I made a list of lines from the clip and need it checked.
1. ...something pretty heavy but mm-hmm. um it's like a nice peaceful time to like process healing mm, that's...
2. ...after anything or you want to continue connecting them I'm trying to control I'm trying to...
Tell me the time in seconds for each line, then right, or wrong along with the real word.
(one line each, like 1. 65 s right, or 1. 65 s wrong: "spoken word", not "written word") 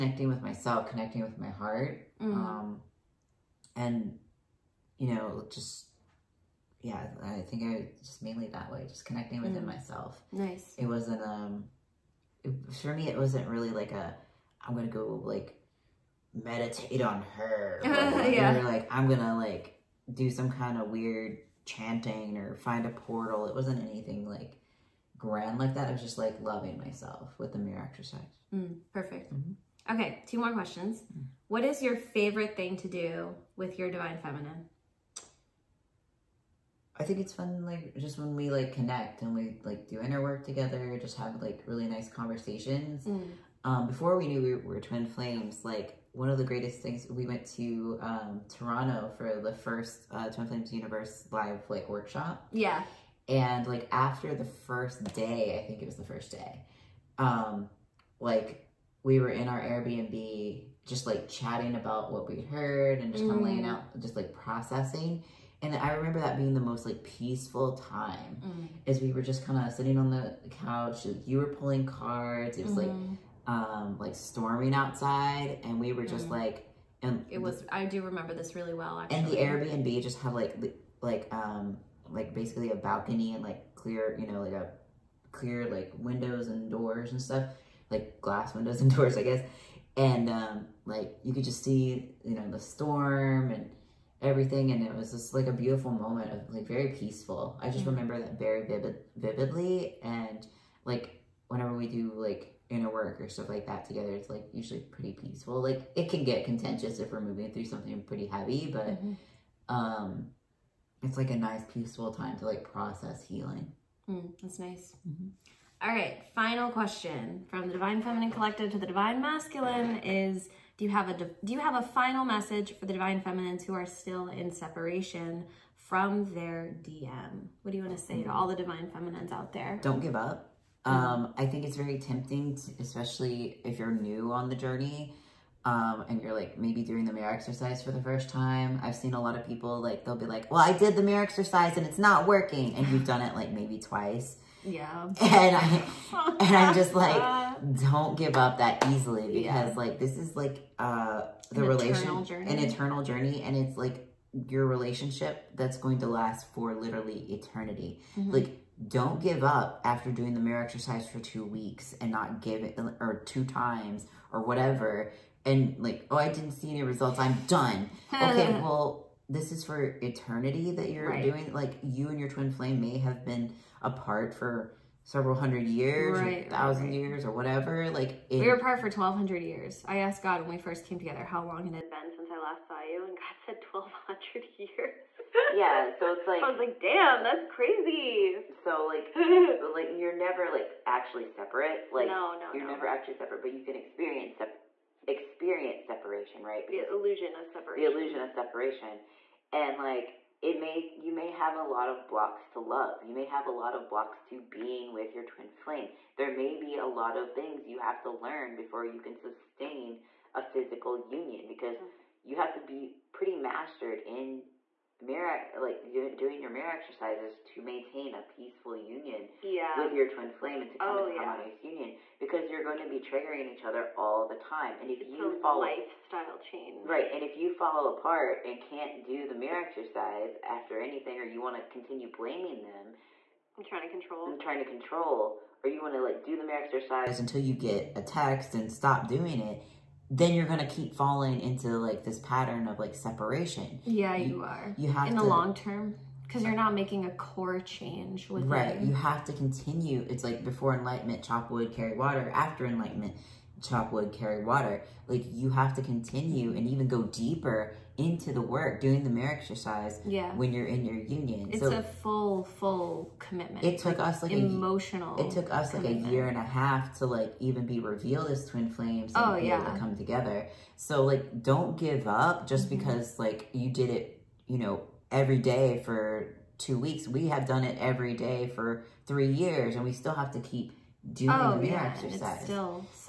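1. 107 s right
2. 230 s wrong: "blaming", not "connecting".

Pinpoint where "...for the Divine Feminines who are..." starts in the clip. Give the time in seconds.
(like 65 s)
122 s.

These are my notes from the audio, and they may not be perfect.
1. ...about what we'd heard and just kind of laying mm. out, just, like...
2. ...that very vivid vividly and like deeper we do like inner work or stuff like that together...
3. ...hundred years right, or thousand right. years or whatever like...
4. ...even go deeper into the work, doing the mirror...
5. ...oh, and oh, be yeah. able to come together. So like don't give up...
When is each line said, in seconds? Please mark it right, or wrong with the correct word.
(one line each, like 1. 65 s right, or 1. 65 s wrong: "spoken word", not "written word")
1. 61 s right
2. 98 s wrong: "whenever", not "deeper"
3. 175 s right
4. 256 s right
5. 269 s right.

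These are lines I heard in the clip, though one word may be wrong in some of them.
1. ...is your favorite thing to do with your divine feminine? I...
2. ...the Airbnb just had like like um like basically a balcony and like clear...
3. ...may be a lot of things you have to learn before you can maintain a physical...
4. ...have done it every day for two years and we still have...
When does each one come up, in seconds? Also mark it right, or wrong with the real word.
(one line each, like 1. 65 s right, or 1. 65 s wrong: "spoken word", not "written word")
1. 31 s right
2. 79 s right
3. 206 s wrong: "sustain", not "maintain"
4. 277 s wrong: "three", not "two".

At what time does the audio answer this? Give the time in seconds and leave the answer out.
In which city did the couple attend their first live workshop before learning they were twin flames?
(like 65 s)
48 s.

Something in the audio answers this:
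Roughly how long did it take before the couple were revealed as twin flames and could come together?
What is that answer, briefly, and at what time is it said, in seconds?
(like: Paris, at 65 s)
a year and a half, at 266 s.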